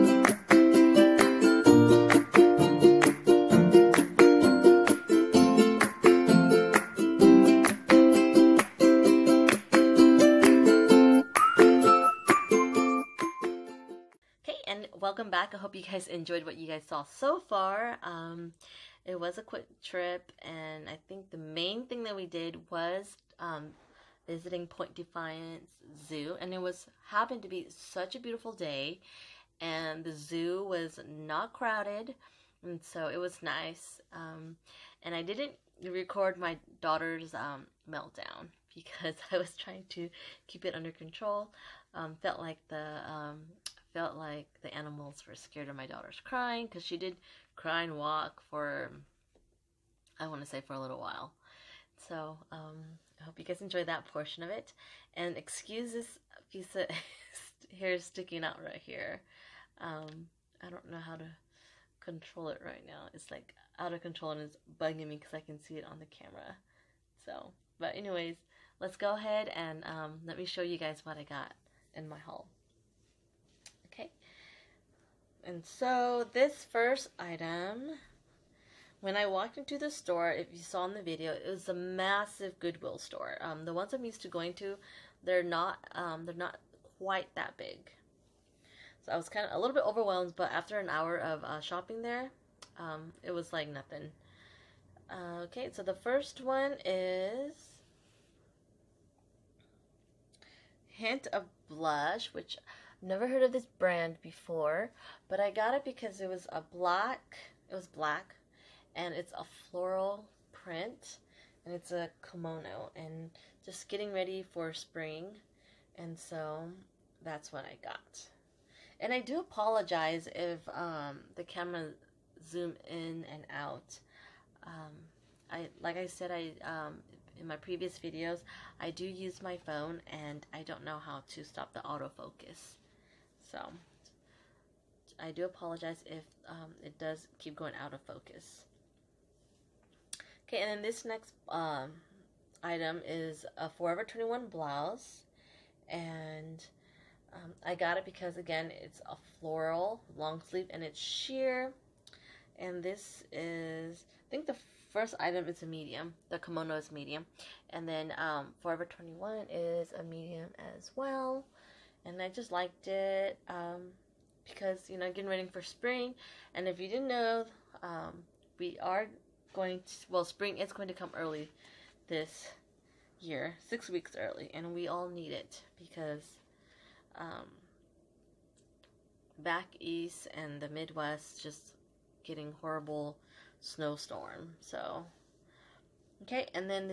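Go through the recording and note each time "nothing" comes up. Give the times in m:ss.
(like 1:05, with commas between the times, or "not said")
1:33.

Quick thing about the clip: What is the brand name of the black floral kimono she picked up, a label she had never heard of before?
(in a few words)
Hint of Blush.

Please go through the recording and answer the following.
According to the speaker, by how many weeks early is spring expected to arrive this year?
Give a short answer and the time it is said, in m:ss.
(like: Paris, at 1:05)
6 weeks, at 2:53.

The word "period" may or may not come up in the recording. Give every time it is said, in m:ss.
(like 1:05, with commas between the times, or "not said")
not said.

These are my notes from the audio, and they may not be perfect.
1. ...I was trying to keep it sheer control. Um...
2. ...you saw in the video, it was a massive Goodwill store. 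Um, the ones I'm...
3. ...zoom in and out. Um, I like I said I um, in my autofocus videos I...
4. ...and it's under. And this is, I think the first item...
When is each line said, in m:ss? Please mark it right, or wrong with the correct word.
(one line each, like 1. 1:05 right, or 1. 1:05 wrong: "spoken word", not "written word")
1. 0:39 wrong: "under", not "sheer"
2. 1:20 right
3. 2:02 wrong: "previous", not "autofocus"
4. 2:30 wrong: "sheer", not "under".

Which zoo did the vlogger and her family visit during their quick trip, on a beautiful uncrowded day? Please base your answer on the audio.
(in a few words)
Point Defiance Zoo.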